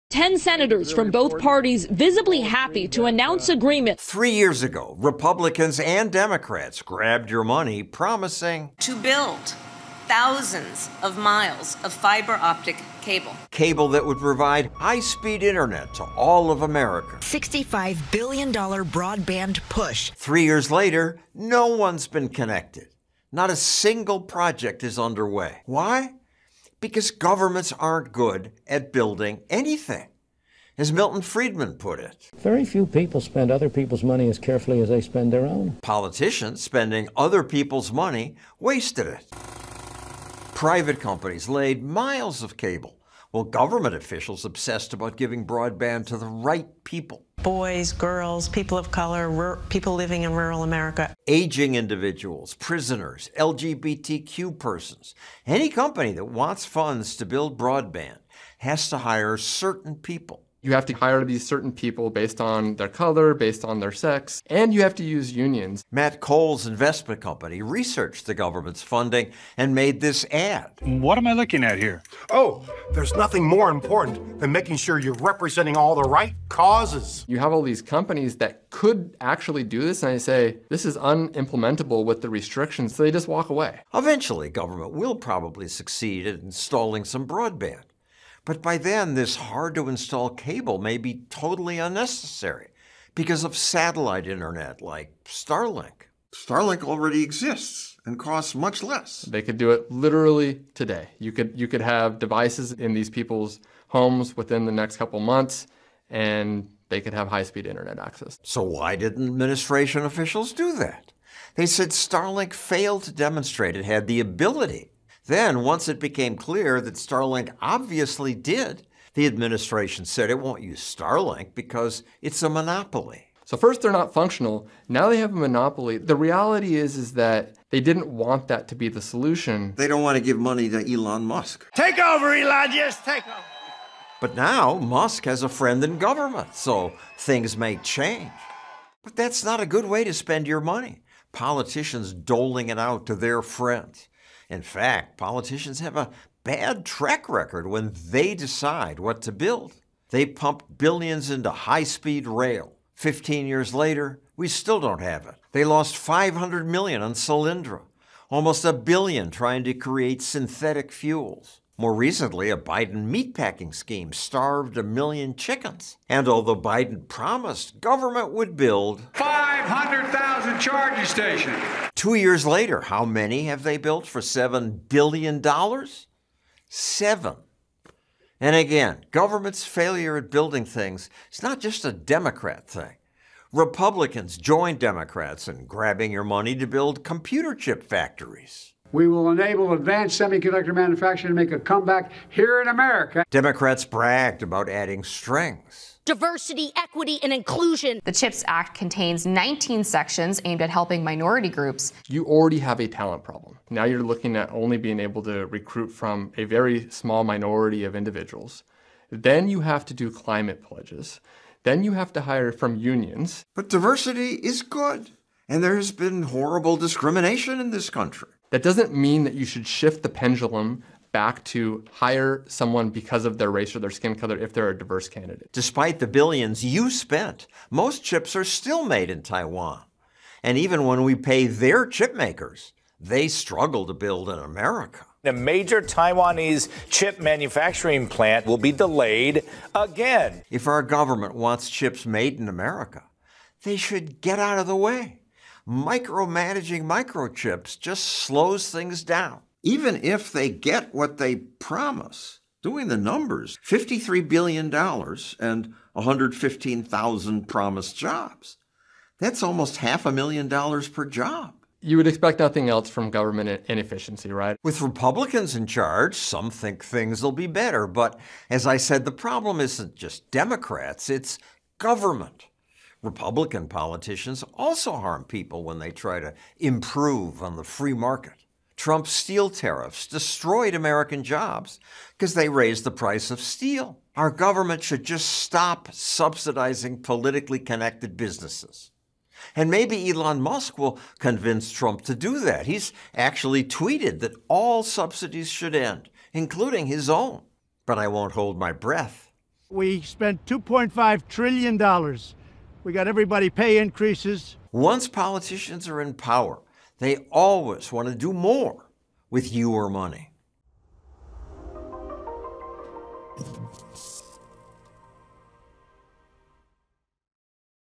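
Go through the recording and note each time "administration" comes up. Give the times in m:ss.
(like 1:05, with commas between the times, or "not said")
1:49, 1:59.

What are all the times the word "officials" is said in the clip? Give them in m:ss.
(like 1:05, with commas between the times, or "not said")
0:43, 1:50.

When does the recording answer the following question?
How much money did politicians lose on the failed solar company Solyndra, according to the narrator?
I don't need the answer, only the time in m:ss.
2:35.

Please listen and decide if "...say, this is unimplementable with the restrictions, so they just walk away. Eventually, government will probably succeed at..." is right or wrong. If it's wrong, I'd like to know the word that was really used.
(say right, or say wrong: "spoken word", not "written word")
right.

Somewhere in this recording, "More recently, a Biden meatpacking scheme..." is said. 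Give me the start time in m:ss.
2:41.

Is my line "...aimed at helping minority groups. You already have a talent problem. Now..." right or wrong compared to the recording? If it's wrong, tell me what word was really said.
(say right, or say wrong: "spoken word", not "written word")
right.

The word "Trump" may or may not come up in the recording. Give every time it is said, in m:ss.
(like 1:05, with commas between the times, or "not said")
4:38, 4:51.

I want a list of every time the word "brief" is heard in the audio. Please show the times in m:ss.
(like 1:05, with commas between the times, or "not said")
not said.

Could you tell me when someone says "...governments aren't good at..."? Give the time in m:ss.
0:27.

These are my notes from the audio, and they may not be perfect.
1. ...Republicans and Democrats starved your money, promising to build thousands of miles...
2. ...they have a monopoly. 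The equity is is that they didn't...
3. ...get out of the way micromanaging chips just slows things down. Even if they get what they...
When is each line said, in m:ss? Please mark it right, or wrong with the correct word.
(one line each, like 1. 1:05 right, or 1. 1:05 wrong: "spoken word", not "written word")
1. 0:04 wrong: "grabbed", not "starved"
2. 2:05 wrong: "reality", not "equity"
3. 4:04 wrong: "microchips", not "chips".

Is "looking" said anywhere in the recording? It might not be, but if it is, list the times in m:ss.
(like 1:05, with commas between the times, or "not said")
1:11, 3:24.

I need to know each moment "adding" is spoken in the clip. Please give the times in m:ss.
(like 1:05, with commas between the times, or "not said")
3:14.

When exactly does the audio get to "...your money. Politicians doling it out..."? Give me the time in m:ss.
2:20.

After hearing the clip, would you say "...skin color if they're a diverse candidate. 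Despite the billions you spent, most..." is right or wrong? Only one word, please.
right.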